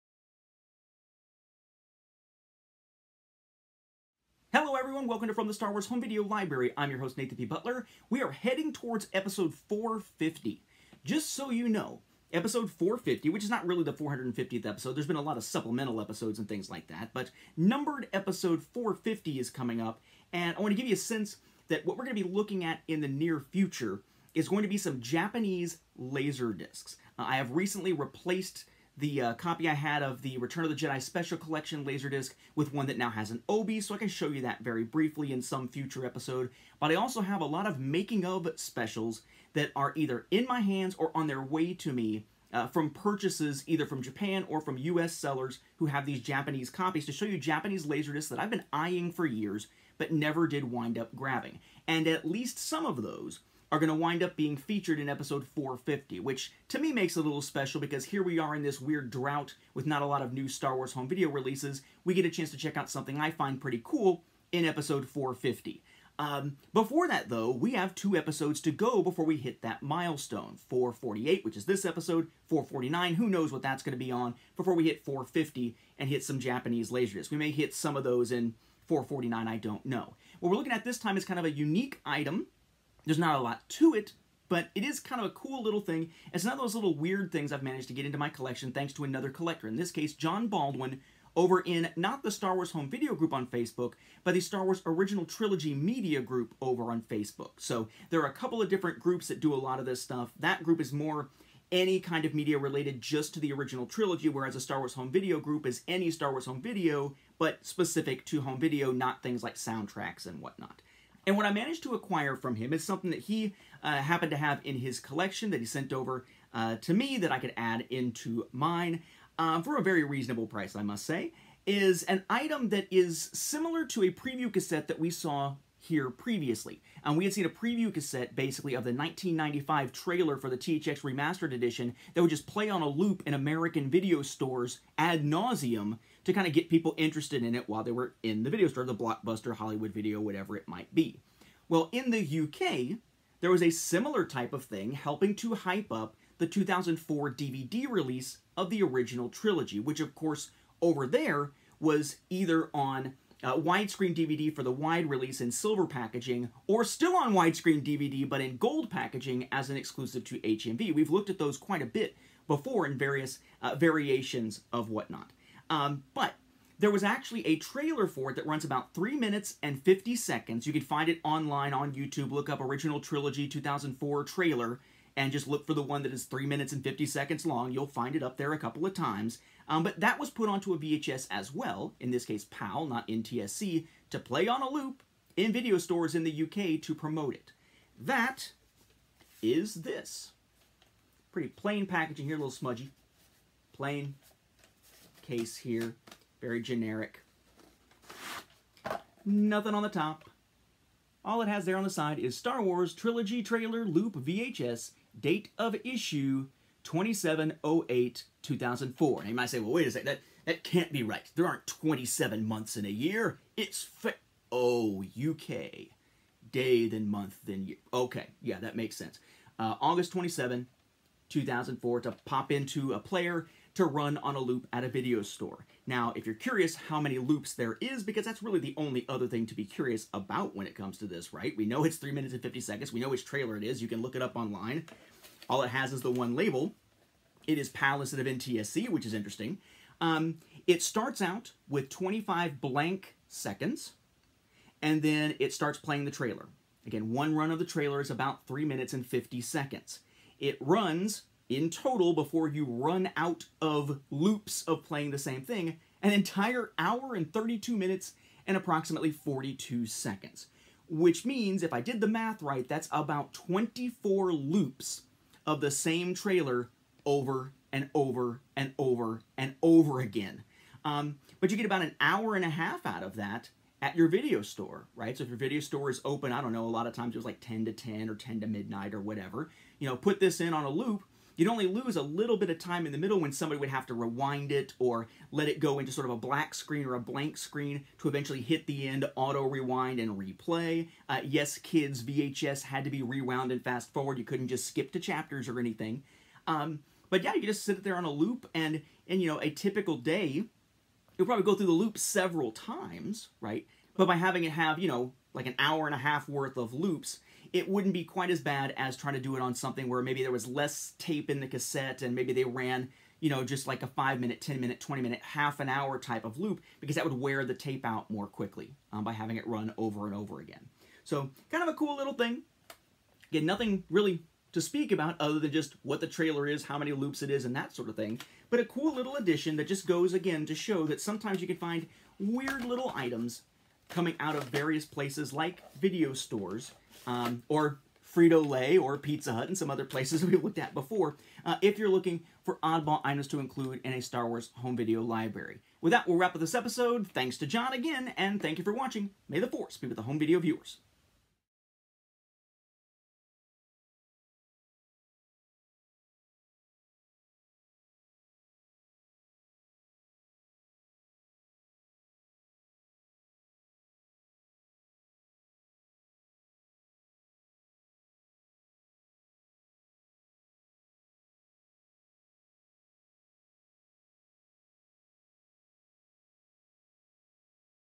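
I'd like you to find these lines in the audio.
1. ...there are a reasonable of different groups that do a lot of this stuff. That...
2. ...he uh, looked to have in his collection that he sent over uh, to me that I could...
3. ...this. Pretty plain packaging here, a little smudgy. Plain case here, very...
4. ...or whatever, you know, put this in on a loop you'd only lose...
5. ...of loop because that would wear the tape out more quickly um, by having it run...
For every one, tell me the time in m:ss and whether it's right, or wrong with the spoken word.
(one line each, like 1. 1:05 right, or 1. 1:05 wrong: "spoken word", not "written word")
1. 1:38 wrong: "couple", not "reasonable"
2. 1:53 wrong: "happened", not "looked"
3. 3:09 right
4. 4:38 right
5. 5:16 right.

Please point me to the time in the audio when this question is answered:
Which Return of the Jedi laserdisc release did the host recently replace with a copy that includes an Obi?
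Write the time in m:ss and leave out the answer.
0:31.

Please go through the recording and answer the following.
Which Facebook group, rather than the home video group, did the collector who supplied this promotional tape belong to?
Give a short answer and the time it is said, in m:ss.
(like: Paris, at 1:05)
Star Wars Original Trilogy Media Group, at 1:34.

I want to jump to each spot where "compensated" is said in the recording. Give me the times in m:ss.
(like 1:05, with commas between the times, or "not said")
not said.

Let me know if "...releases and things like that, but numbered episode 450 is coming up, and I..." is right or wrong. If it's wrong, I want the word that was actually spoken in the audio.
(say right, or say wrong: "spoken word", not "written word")
wrong: "episodes", not "releases".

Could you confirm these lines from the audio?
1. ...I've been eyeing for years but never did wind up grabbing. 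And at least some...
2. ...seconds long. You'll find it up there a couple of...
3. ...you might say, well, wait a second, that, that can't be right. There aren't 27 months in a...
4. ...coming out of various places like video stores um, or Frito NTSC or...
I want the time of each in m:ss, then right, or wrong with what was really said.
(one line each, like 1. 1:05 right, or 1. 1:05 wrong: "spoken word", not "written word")
1. 0:48 right
2. 2:57 right
3. 3:29 right
4. 5:33 wrong: "Lay", not "NTSC".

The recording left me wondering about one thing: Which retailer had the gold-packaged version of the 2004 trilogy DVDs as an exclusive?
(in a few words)
HMV.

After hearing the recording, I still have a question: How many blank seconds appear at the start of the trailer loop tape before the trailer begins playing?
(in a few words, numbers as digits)
25.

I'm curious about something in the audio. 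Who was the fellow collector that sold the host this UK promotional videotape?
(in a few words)
John Baldwin.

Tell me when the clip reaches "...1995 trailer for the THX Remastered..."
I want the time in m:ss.
2:08.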